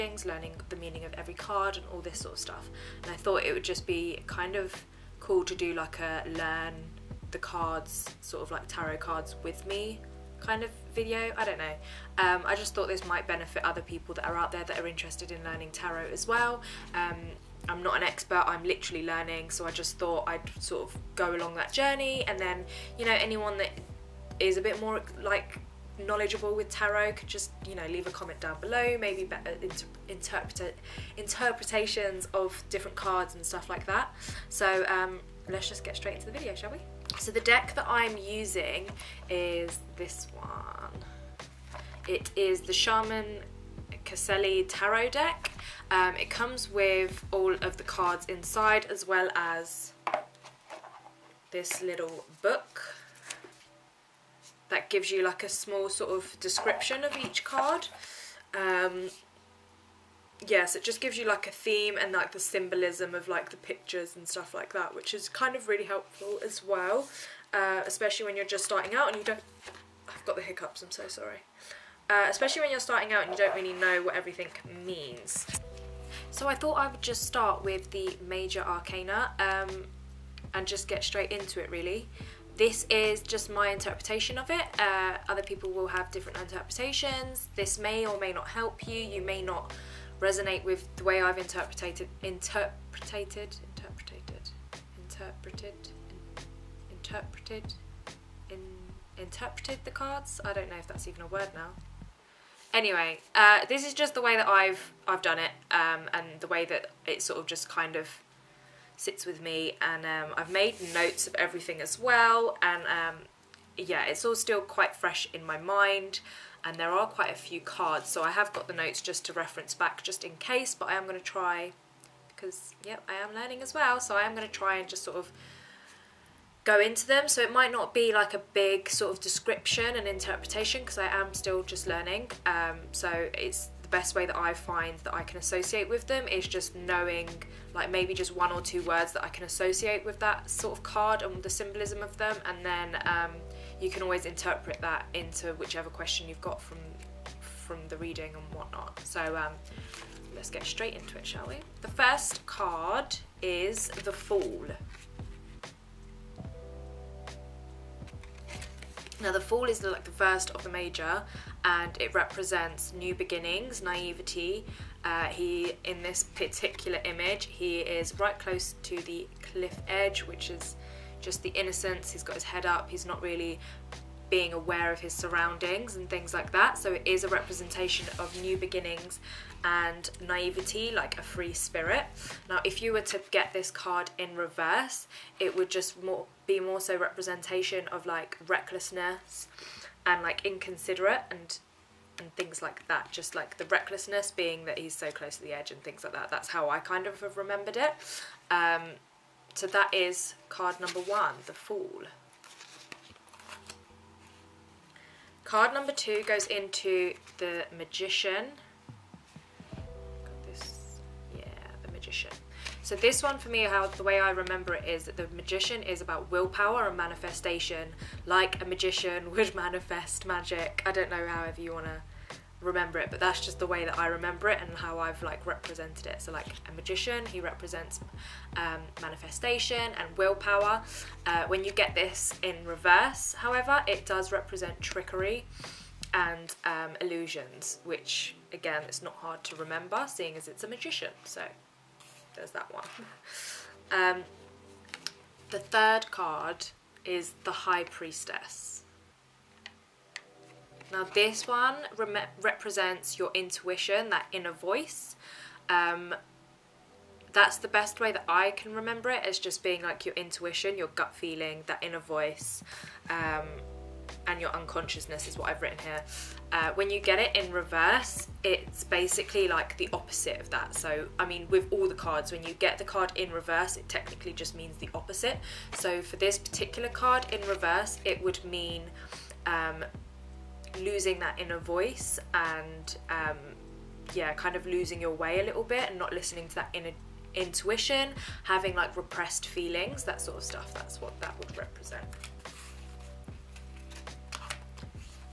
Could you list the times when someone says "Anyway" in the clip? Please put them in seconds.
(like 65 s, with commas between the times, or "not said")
102 s.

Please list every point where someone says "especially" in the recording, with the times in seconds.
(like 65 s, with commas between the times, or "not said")
67 s, 72 s.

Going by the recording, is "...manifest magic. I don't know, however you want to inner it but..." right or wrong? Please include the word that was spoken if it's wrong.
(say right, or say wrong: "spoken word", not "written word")
wrong: "remember", not "inner".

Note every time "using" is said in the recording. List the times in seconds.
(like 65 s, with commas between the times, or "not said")
38 s.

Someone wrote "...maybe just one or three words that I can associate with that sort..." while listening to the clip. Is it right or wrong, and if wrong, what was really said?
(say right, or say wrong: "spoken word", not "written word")
wrong: "two", not "three".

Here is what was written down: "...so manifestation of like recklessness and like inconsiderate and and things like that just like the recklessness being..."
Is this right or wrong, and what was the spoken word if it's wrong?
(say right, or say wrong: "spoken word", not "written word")
wrong: "representation", not "manifestation".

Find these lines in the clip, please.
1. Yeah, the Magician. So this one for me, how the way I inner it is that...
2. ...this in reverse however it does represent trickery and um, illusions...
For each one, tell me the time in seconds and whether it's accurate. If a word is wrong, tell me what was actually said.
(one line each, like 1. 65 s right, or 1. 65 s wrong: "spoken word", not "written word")
1. 211 s wrong: "remember", not "inner"
2. 231 s right.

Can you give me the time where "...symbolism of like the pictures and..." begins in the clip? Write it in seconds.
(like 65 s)
62 s.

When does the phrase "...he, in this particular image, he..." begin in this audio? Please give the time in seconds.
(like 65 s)
165 s.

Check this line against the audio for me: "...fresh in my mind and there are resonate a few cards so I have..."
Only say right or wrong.
wrong.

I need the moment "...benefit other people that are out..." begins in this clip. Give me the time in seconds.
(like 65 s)
13 s.